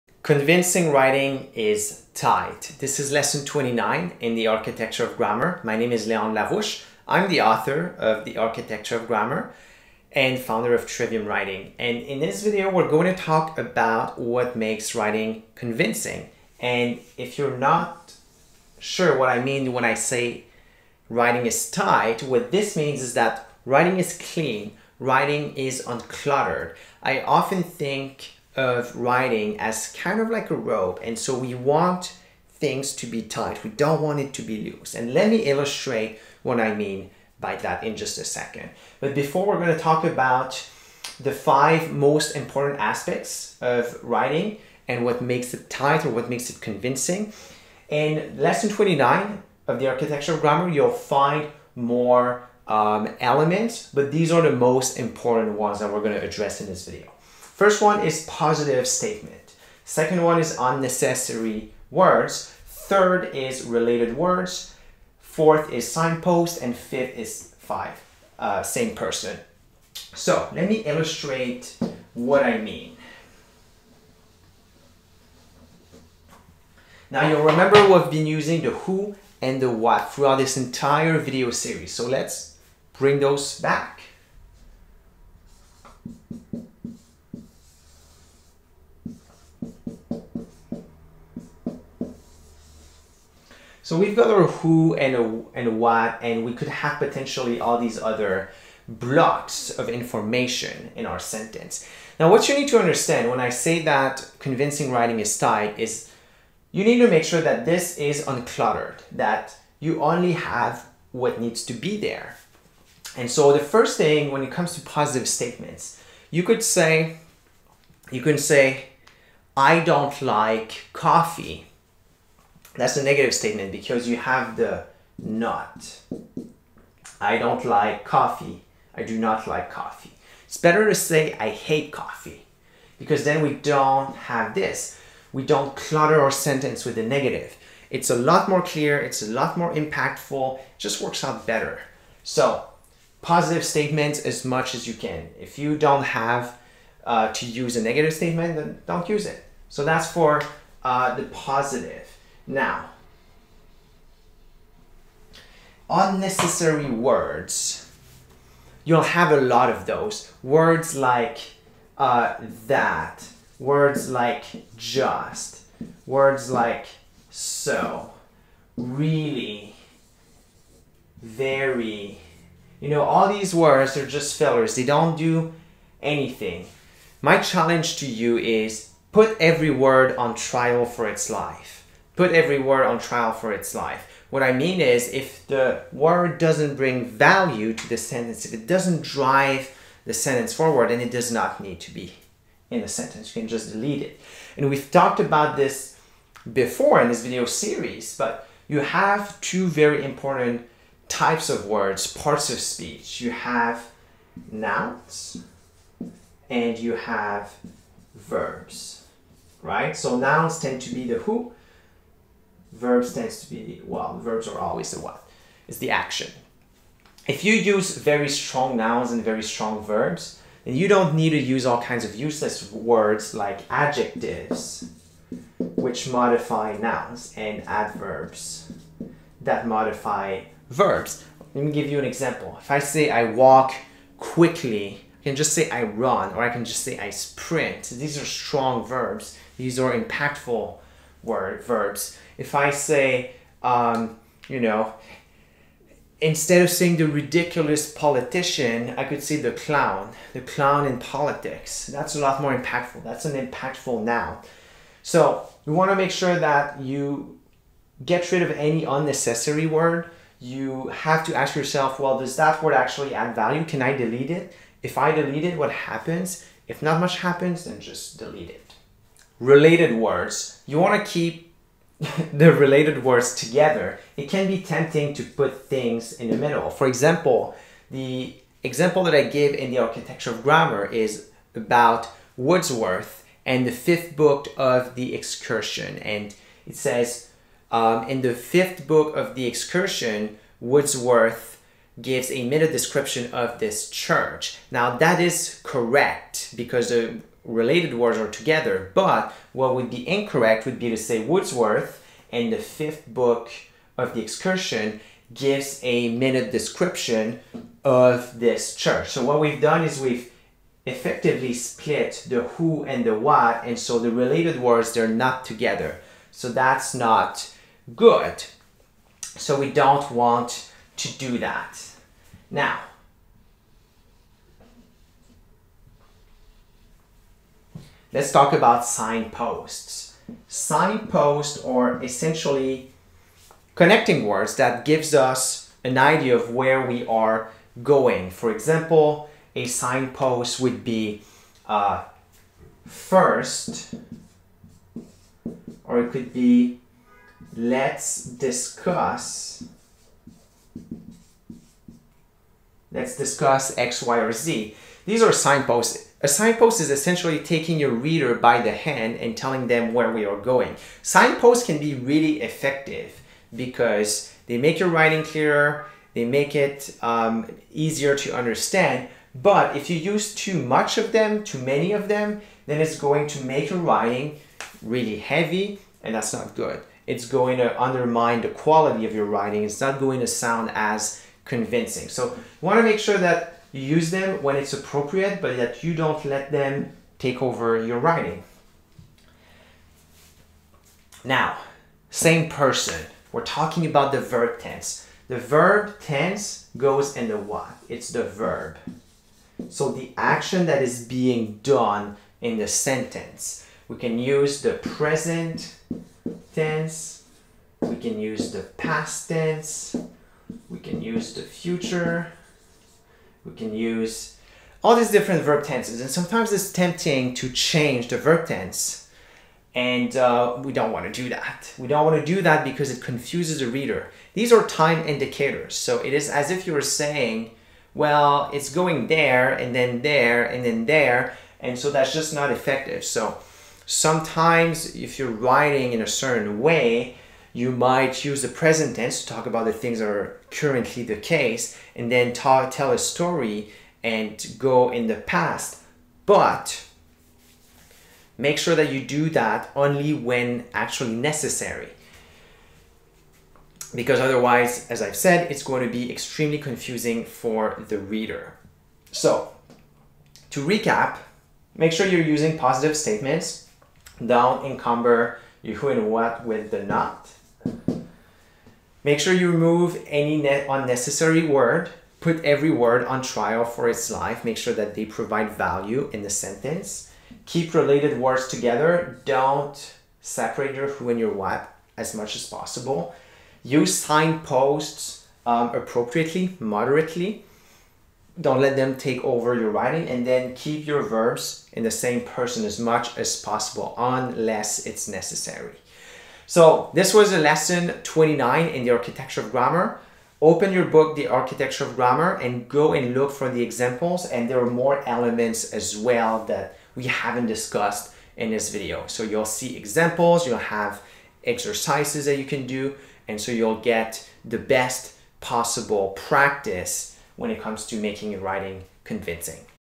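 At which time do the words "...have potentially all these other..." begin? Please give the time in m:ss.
1:36.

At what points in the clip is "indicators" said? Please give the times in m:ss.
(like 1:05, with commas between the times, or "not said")
7:05.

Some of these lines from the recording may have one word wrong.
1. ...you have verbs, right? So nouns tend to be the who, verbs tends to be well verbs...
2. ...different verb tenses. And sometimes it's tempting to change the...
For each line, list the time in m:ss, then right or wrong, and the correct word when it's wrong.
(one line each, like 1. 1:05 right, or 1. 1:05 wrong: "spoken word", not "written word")
1. 3:26 right
2. 6:55 right.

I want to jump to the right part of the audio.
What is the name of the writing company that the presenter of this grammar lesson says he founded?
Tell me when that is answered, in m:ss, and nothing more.
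0:10.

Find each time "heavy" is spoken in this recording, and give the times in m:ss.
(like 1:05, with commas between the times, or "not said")
6:15.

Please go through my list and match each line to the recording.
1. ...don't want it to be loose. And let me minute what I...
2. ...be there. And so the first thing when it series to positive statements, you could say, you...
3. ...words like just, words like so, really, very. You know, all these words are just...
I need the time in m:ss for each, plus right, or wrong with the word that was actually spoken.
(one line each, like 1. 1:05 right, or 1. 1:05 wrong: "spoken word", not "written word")
1. 0:33 wrong: "illustrate", not "minute"
2. 1:51 wrong: "comes", not "series"
3. 2:43 right.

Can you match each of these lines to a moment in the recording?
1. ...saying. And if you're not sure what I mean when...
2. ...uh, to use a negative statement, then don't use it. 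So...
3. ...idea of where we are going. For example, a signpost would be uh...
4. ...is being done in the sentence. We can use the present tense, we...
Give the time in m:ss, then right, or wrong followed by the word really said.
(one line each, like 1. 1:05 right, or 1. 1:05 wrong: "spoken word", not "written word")
1. 0:15 wrong: "convincing", not "saying"
2. 2:27 right
3. 5:35 right
4. 6:40 right.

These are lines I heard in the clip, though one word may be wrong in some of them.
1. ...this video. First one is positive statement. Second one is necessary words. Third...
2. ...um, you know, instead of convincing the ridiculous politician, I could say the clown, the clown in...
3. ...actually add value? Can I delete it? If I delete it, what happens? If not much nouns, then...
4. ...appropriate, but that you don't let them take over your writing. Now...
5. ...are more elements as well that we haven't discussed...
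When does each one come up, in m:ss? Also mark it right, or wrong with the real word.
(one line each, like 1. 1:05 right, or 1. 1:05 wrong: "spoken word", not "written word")
1. 0:56 wrong: "unnecessary", not "necessary"
2. 4:03 wrong: "saying", not "convincing"
3. 4:22 wrong: "happens", not "nouns"
4. 6:24 right
5. 8:24 right.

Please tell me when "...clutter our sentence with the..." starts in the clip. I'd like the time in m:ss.
2:15.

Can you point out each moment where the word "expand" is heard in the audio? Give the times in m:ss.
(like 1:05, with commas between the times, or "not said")
not said.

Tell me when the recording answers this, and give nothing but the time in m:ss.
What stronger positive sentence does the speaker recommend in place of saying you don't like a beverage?
2:11.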